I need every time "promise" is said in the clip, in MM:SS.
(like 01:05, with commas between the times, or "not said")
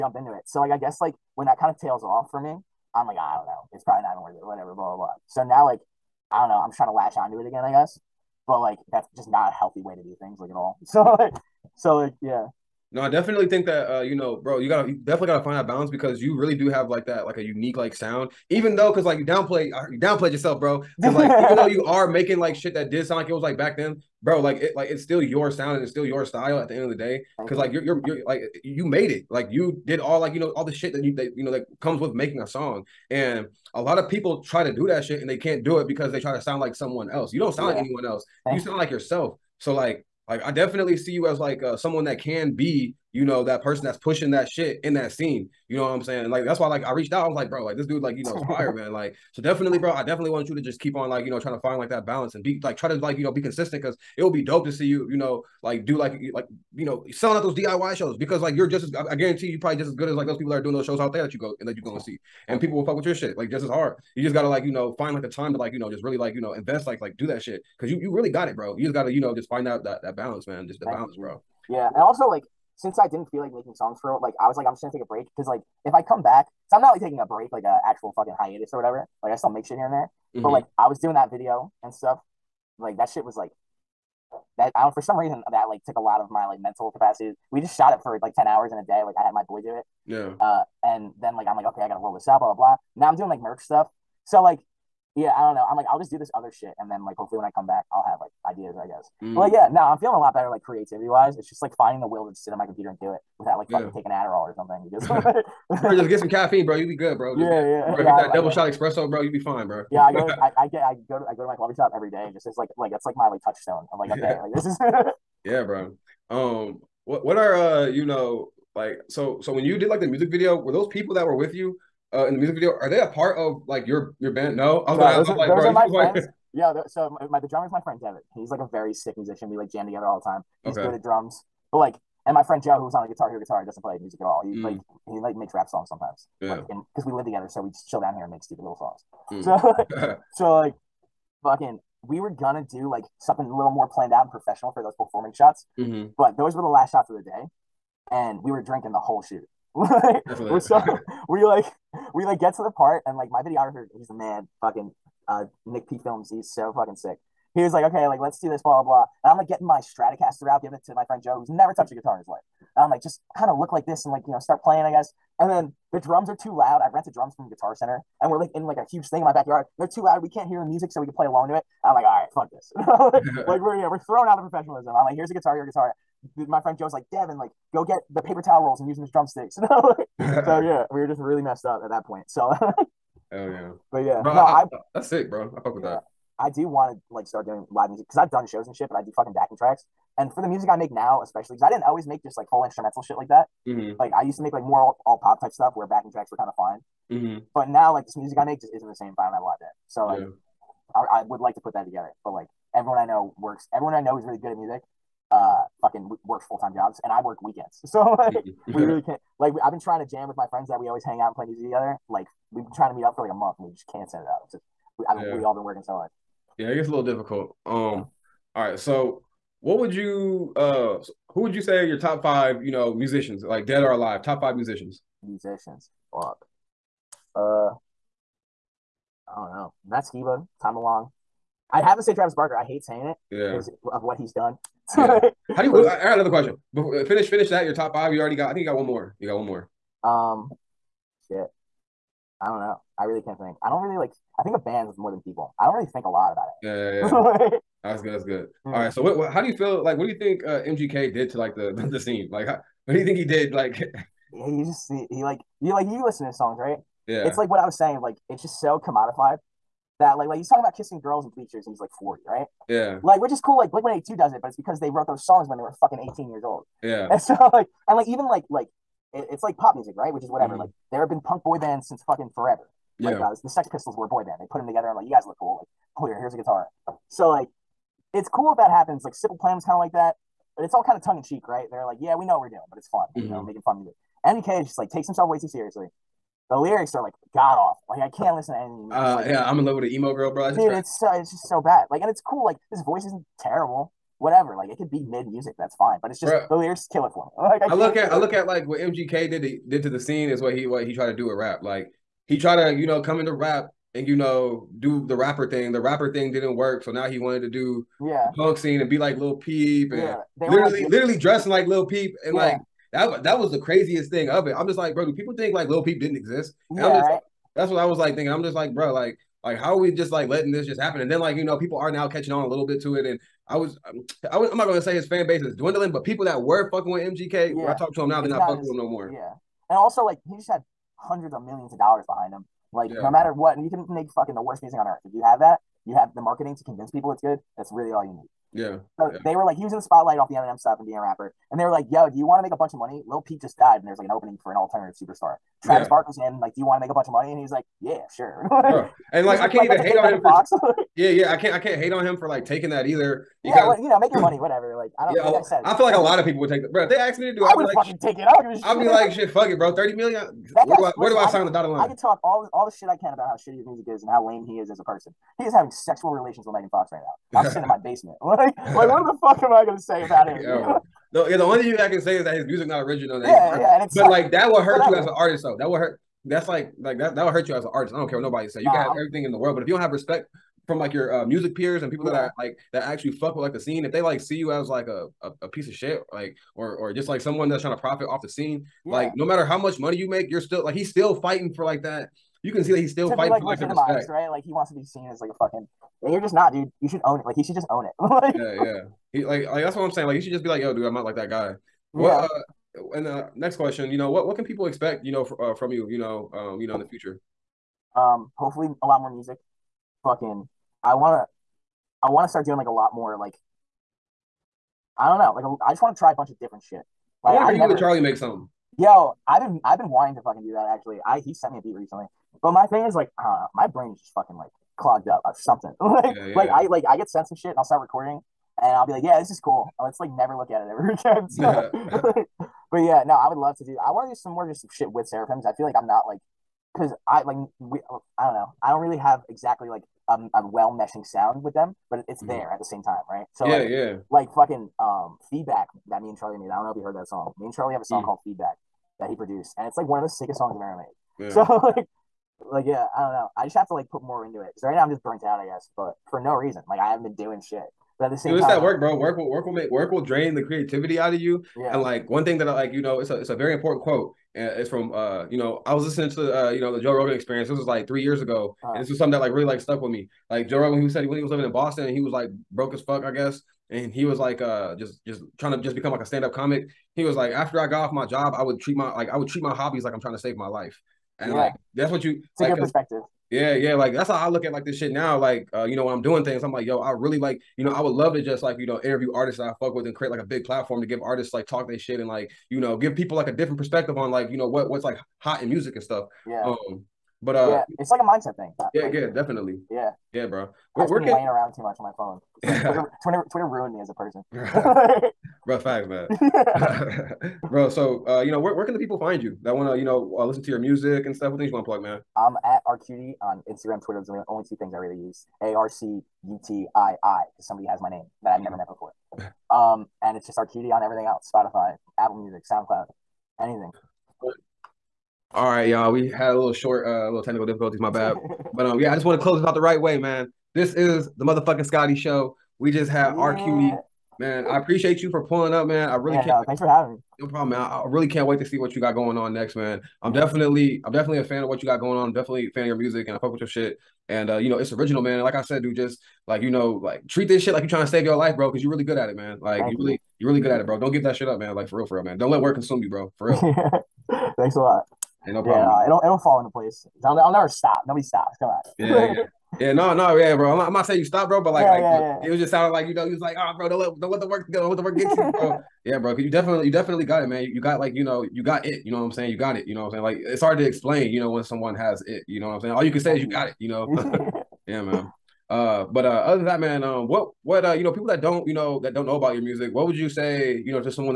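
not said.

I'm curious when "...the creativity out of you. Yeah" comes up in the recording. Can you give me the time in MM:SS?
07:40.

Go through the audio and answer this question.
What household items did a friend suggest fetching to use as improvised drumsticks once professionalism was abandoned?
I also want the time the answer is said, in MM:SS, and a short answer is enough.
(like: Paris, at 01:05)
Paper towel rolls, at 02:58.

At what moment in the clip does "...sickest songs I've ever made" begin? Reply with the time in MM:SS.
07:30.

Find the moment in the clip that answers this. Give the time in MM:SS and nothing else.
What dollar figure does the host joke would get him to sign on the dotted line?
05:59.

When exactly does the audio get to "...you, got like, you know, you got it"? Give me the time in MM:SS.
09:27.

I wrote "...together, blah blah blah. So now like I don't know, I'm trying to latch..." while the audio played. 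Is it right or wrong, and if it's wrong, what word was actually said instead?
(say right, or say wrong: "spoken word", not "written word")
wrong: "whatever", not "together".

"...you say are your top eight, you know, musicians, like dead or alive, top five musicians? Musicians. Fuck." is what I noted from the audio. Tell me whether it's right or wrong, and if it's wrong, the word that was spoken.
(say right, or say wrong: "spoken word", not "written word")
wrong: "five", not "eight".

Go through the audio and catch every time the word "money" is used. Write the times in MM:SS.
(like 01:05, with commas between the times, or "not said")
05:42, 05:47, 05:54, 06:29.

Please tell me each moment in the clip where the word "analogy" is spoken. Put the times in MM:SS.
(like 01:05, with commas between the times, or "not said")
not said.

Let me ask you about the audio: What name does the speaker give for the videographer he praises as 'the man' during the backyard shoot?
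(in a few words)
Nick P Films.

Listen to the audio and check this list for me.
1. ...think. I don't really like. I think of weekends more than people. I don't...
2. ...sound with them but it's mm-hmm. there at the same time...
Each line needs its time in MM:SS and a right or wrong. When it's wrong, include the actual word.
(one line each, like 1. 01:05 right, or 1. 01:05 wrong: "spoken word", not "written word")
1. 04:03 wrong: "bands", not "weekends"
2. 07:21 right.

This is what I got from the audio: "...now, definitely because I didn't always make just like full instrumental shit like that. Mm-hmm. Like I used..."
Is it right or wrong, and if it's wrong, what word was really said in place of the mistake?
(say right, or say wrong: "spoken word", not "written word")
wrong: "especially", not "definitely".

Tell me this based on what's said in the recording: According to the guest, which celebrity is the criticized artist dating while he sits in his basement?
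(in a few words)
Megan Fox.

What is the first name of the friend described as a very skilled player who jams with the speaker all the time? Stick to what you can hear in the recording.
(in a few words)
David.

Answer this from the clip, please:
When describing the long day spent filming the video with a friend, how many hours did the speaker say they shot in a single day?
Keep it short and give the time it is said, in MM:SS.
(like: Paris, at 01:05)
10, at 01:28.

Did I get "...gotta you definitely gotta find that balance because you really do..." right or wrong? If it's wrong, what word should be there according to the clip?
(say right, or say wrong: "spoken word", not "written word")
right.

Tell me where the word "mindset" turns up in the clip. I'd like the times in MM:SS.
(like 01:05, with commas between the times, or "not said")
08:18.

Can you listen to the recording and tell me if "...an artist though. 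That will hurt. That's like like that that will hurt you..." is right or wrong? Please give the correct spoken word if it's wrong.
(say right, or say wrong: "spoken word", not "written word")
right.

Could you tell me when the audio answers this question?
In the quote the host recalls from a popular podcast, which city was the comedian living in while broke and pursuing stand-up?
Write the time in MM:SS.
07:51.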